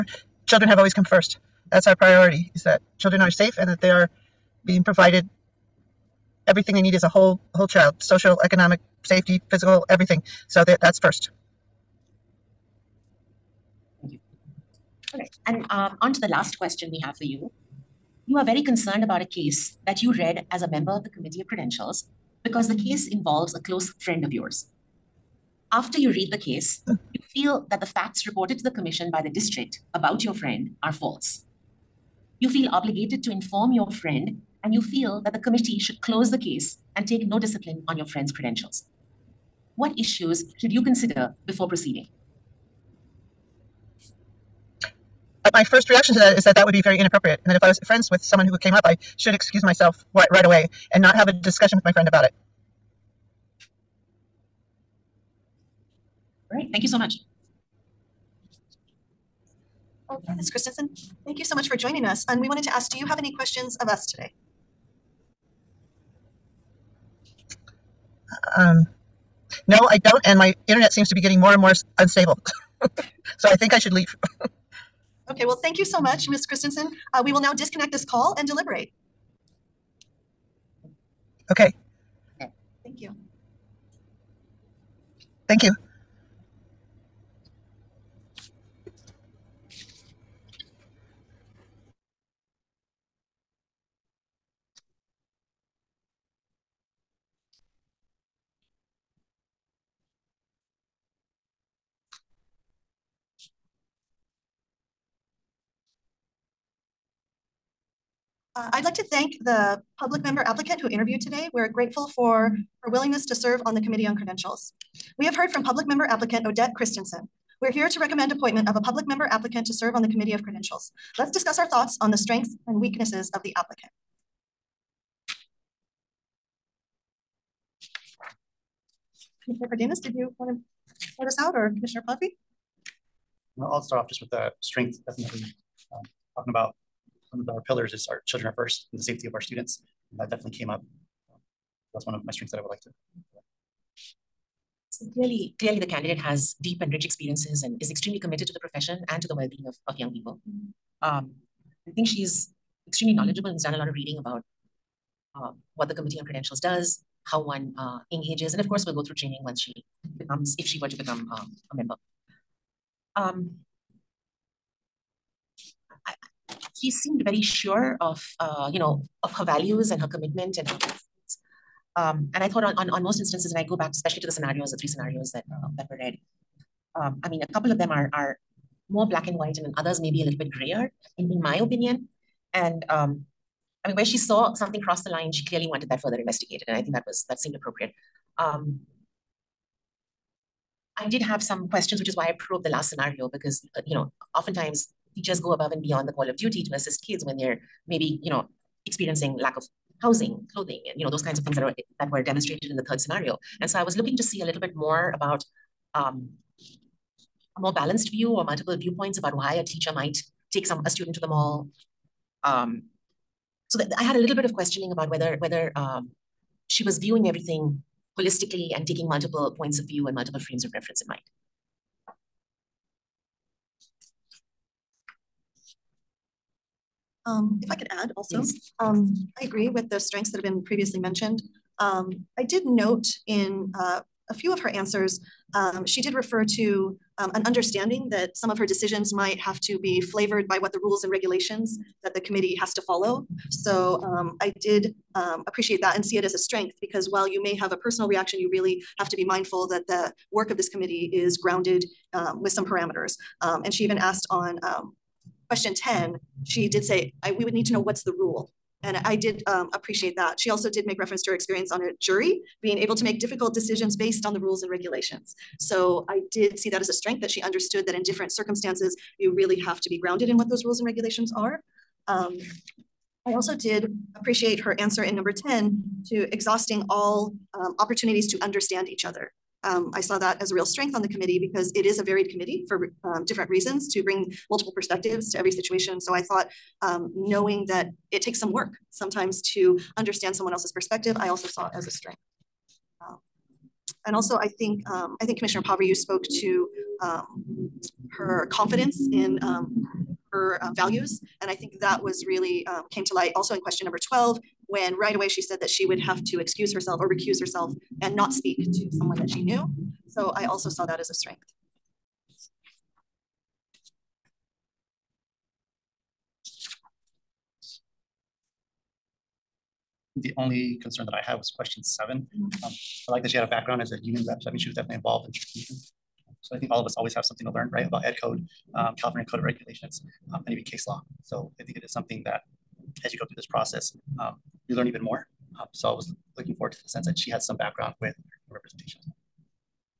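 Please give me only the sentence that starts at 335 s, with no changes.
Um, so I was looking forward to the sense that she had some background with representation.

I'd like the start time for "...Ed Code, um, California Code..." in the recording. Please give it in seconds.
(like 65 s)
328 s.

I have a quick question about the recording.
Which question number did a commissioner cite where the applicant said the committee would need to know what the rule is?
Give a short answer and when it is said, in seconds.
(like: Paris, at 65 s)
10, at 255 s.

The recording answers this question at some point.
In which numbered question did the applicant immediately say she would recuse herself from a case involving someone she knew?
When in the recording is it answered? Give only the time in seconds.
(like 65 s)
303 s.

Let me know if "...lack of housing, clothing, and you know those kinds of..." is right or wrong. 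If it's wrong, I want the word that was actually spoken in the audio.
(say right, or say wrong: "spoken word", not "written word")
right.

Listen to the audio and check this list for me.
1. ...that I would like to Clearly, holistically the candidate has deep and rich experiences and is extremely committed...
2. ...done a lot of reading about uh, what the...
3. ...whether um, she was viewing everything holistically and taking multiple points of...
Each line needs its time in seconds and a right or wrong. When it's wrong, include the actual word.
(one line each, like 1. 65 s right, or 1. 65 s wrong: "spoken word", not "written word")
1. 142 s wrong: "clearly", not "holistically"
2. 153 s right
3. 215 s right.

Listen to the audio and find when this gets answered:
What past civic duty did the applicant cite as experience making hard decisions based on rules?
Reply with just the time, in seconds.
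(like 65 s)
261 s.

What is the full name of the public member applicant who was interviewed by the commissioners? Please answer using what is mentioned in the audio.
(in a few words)
Odette Christensen.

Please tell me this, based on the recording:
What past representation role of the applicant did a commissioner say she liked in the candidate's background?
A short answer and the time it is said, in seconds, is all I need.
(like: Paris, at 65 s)
union rep, at 324 s.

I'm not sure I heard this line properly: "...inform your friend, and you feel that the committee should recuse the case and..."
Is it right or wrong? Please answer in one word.
wrong.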